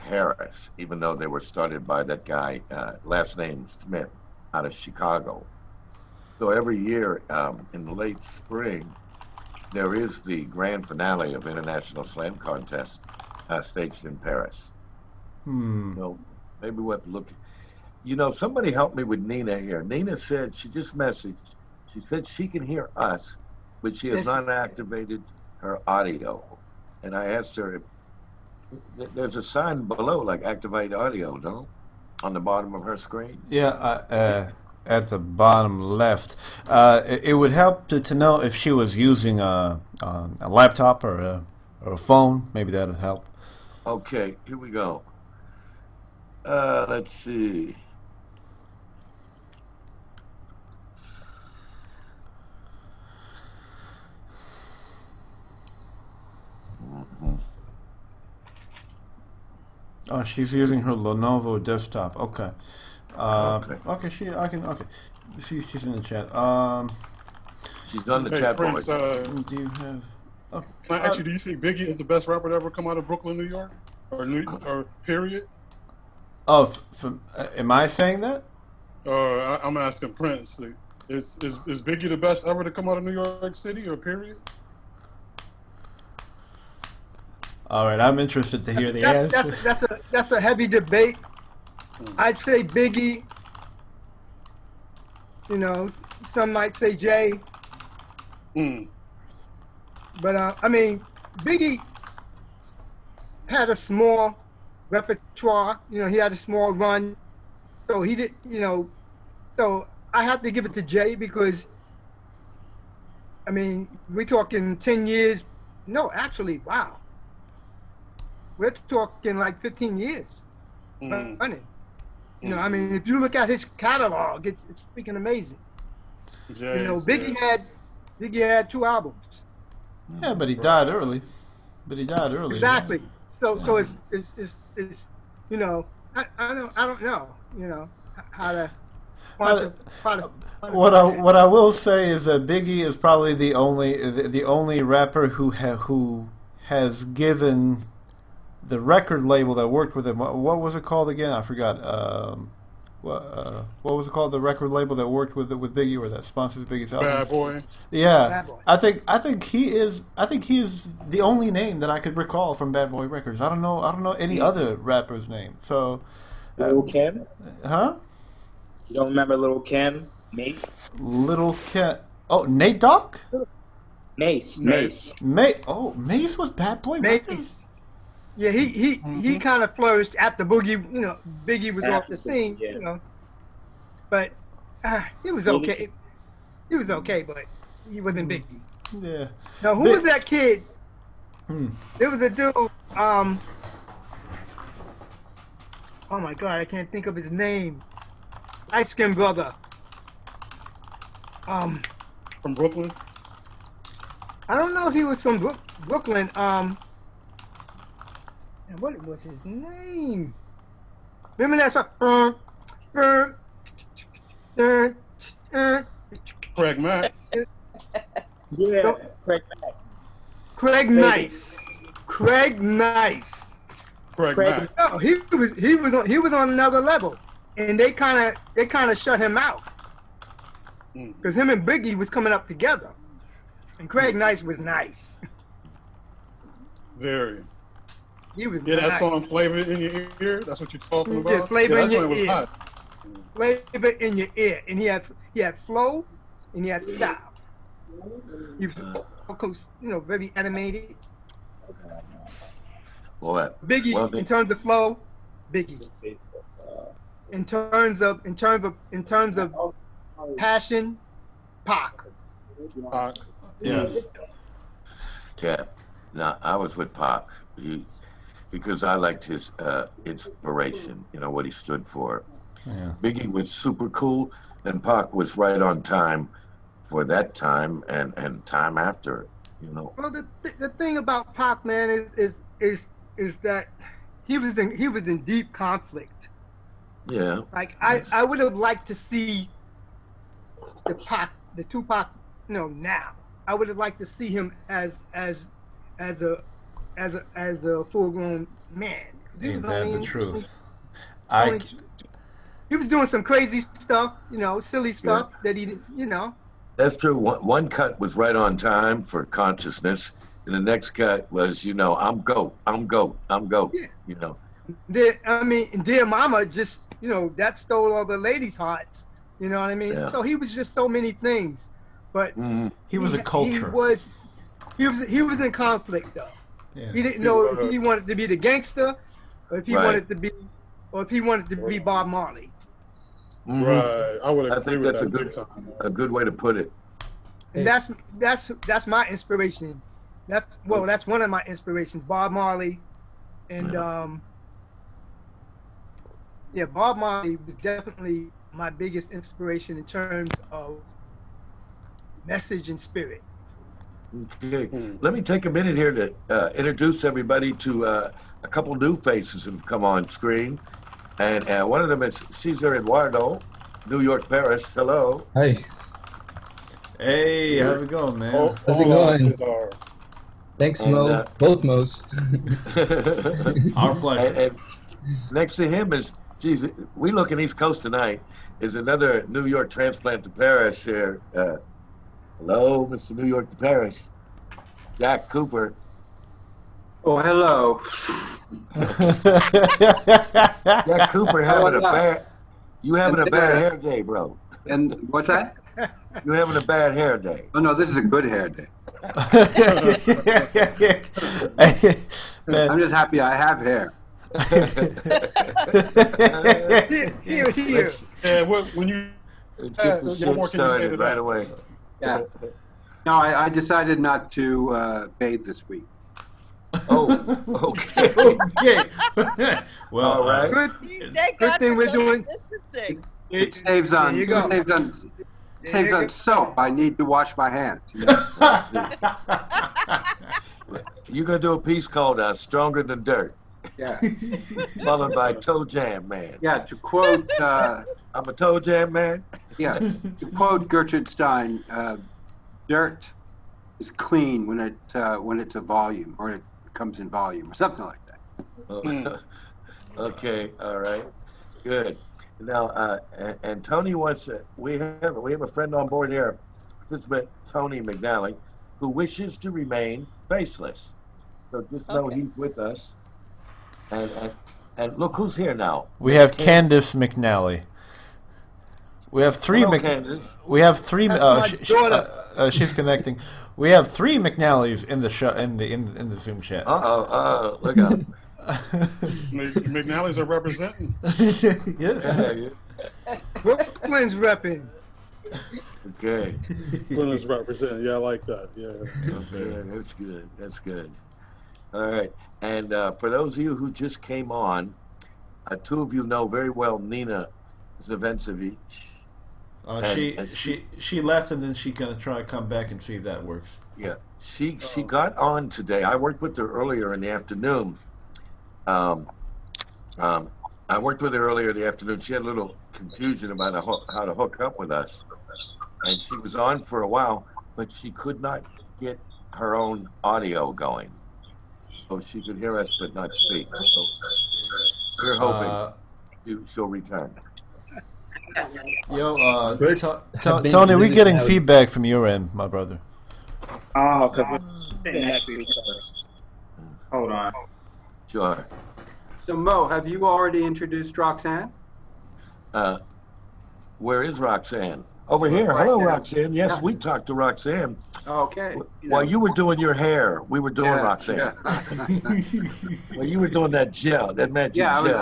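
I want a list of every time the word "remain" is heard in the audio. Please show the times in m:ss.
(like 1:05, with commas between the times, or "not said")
7:39.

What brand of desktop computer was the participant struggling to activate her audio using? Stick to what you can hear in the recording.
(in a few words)
Lenovo.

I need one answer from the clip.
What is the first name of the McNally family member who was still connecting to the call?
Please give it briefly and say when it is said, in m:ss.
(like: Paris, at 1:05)
Candace, at 7:46.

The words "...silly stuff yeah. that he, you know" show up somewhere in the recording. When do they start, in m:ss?
5:04.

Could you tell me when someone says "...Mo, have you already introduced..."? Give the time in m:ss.
8:59.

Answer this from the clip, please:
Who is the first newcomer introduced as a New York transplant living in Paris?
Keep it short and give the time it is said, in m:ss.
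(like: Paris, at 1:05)
Cesar Eduardo, at 6:02.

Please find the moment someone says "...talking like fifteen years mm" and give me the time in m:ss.
1:58.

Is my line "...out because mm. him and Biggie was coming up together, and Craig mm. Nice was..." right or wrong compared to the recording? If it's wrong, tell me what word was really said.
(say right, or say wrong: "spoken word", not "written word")
right.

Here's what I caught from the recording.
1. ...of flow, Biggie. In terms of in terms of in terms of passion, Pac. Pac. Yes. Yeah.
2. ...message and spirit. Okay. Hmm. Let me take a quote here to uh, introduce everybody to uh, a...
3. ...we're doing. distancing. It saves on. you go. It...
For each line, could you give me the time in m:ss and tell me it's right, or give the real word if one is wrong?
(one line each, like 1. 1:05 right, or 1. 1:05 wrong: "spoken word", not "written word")
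1. 4:14 right
2. 5:52 wrong: "minute", not "quote"
3. 7:01 right.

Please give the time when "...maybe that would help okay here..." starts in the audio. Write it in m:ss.
0:42.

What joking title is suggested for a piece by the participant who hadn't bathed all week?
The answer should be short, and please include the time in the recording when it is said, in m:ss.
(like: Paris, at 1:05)
Stronger Than Dirt, at 7:12.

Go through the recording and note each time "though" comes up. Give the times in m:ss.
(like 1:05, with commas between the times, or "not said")
0:00, 5:26.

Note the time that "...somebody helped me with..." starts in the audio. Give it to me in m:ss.
0:18.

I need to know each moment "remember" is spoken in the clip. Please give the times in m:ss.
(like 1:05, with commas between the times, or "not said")
2:49, 3:31.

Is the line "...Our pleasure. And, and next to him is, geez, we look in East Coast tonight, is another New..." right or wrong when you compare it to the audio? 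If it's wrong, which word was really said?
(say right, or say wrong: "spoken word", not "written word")
right.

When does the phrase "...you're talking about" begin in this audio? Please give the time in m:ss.
4:00.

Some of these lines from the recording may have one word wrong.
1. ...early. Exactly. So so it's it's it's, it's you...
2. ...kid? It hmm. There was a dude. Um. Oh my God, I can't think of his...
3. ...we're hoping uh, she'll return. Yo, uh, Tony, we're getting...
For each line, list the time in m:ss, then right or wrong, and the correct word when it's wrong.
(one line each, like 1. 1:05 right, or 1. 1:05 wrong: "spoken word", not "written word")
1. 2:12 right
2. 3:10 right
3. 8:45 right.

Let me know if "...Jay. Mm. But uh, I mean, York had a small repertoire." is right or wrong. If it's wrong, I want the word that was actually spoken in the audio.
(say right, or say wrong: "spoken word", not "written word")
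wrong: "Biggie", not "York".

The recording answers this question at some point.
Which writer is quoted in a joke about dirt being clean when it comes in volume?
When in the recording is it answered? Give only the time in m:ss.
7:20.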